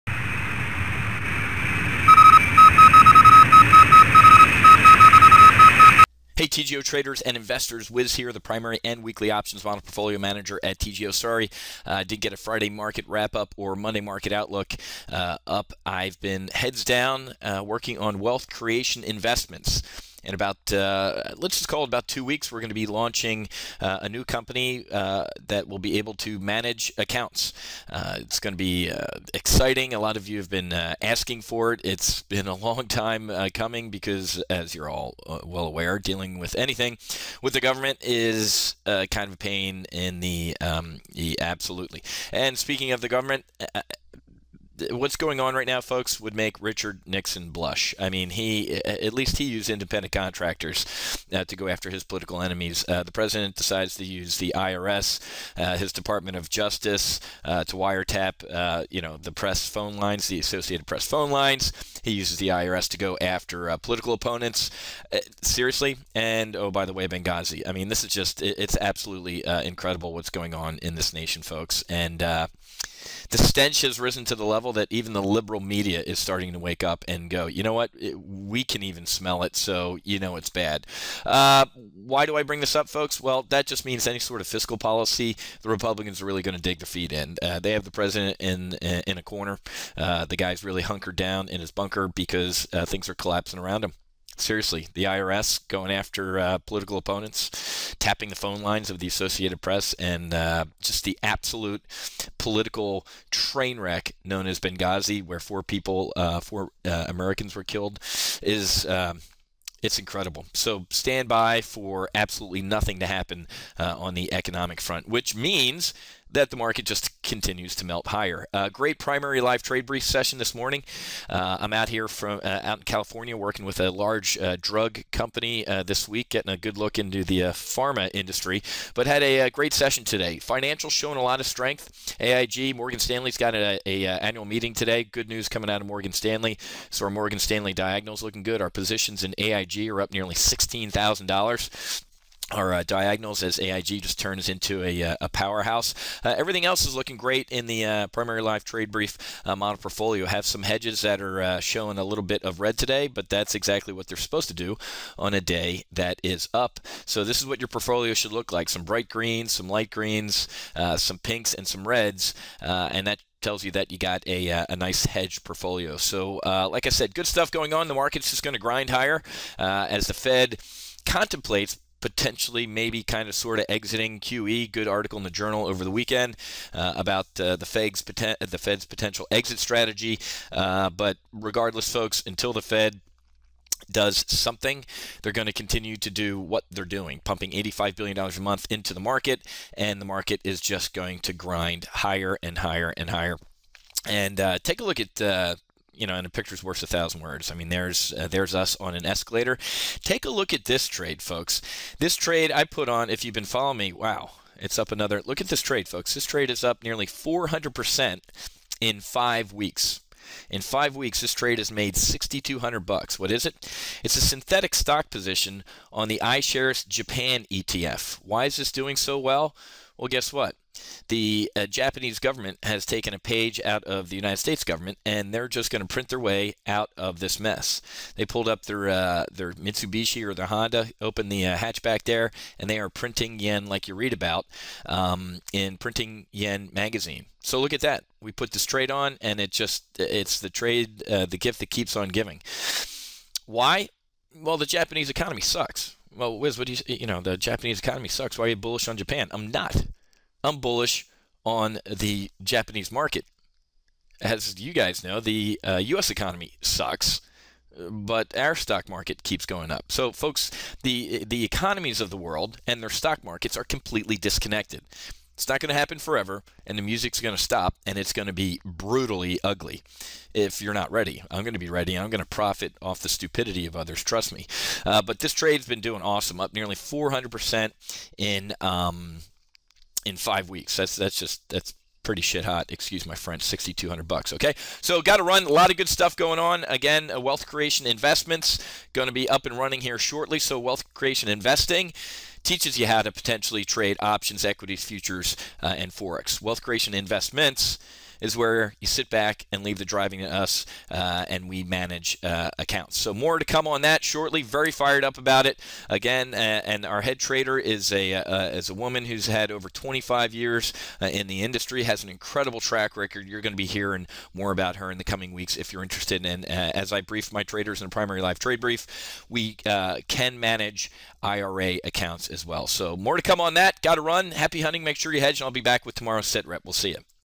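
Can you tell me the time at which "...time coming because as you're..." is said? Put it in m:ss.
0:32.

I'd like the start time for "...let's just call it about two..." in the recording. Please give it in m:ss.
0:21.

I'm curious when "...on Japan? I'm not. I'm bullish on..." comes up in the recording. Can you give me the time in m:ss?
4:08.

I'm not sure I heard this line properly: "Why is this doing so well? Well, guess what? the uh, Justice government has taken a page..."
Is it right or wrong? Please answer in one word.
wrong.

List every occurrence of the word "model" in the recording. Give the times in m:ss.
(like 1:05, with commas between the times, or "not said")
0:09, 2:29.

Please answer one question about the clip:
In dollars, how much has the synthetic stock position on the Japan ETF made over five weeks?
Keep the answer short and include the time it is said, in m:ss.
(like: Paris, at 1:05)
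$6,200, at 3:31.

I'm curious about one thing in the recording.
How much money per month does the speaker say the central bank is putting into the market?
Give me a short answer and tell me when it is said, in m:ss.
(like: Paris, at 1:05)
$85 billion, at 3:07.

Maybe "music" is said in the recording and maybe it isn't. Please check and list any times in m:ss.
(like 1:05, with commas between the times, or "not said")
4:26.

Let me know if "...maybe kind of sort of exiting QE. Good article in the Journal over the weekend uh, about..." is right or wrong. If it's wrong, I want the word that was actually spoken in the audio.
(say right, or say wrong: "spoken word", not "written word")
right.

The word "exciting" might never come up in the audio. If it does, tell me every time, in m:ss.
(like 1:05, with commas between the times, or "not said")
0:29.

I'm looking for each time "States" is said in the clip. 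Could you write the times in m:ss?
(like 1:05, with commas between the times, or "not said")
3:44.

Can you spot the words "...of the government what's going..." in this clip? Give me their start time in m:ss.
0:42.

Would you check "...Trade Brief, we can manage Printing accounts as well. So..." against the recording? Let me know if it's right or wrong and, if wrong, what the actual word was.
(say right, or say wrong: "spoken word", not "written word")
wrong: "IRA", not "Printing".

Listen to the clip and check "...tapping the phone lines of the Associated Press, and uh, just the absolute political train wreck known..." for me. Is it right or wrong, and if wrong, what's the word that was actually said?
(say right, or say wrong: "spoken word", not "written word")
right.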